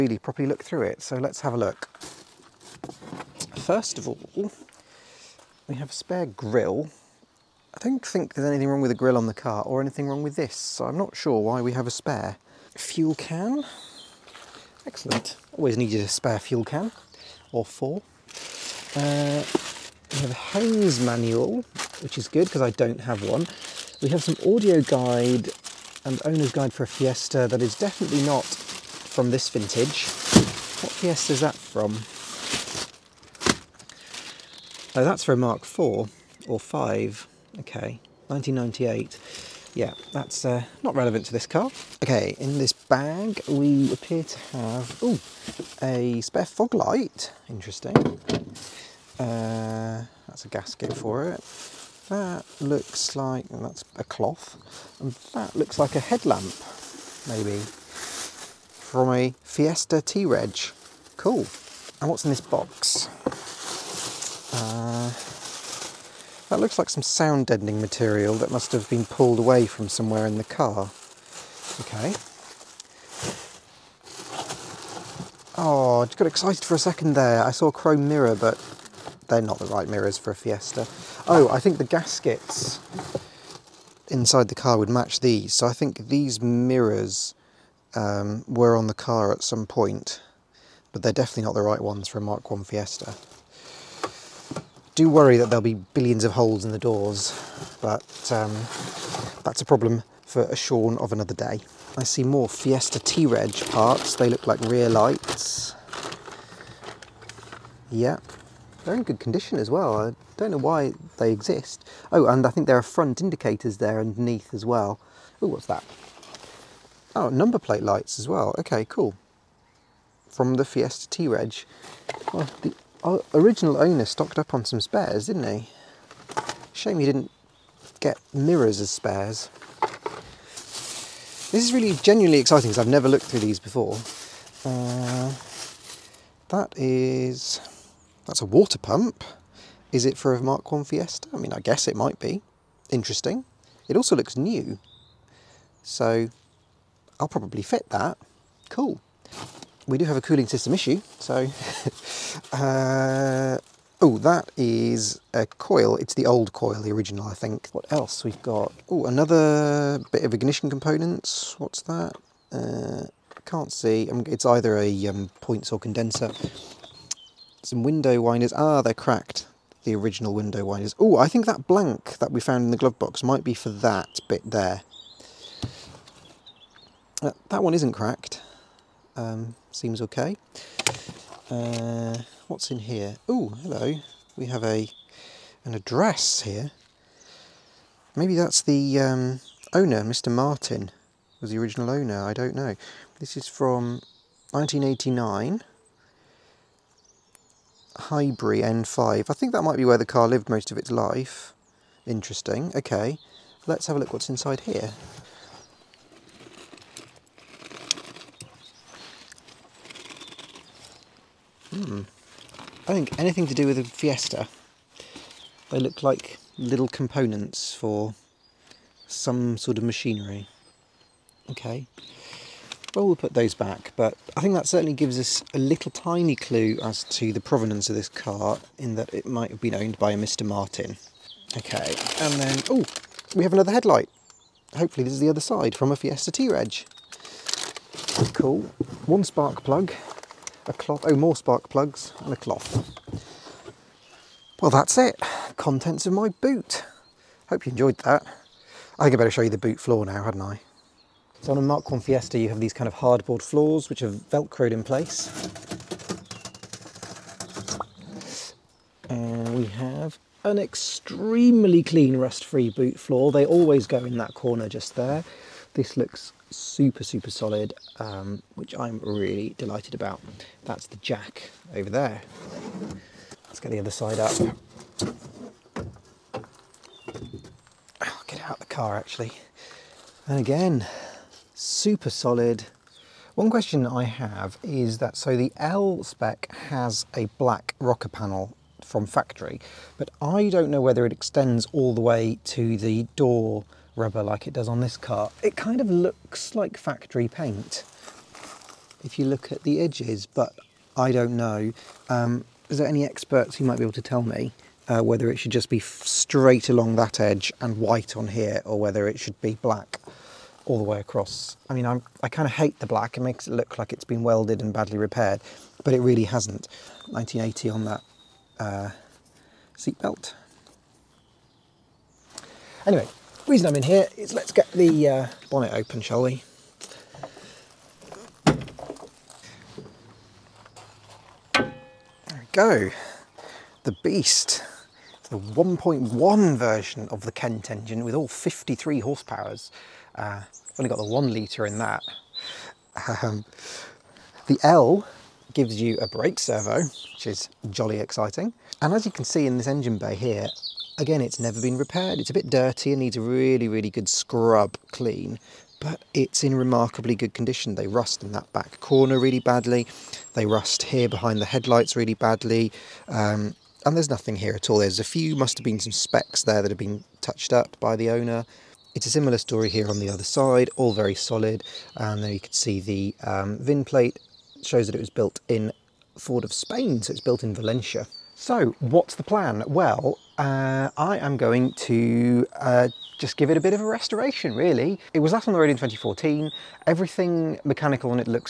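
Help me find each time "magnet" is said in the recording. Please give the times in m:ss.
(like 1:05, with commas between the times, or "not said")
not said.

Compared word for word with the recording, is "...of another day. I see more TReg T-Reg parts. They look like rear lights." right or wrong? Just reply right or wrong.
wrong.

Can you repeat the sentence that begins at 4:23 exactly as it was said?
They always go in that corner just there.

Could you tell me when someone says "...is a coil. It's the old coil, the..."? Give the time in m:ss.
2:34.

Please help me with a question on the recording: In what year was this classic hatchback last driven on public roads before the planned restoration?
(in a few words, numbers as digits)
2014.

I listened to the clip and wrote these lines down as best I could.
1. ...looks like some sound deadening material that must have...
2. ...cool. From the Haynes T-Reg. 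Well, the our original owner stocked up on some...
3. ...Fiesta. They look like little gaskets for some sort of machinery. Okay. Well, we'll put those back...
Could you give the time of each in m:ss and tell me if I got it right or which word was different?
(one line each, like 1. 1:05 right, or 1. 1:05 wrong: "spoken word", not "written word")
1. 1:06 right
2. 1:58 wrong: "Fiesta", not "Haynes"
3. 3:33 wrong: "components", not "gaskets".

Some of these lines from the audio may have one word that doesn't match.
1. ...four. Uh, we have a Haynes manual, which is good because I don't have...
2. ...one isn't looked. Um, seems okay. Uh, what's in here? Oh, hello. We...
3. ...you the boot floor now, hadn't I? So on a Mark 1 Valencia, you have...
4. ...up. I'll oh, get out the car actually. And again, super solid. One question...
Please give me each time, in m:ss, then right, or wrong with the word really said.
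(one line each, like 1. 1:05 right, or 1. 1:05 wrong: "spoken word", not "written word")
1. 0:17 right
2. 2:57 wrong: "cracked", not "looked"
3. 4:09 wrong: "Fiesta", not "Valencia"
4. 4:34 right.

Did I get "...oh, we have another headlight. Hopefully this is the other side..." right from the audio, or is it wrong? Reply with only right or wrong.
right.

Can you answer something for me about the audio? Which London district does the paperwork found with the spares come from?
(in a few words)
Highbury N5.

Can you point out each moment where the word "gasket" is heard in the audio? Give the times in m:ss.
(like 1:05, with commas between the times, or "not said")
0:50, 1:21.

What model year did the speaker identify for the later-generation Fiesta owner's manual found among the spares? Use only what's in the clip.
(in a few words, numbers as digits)
1998.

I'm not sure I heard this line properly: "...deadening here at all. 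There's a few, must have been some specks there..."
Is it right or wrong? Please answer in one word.
wrong.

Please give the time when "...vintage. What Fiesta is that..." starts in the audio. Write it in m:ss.
0:29.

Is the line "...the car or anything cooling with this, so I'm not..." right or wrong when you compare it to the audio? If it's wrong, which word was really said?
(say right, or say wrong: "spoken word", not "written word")
wrong: "wrong", not "cooling".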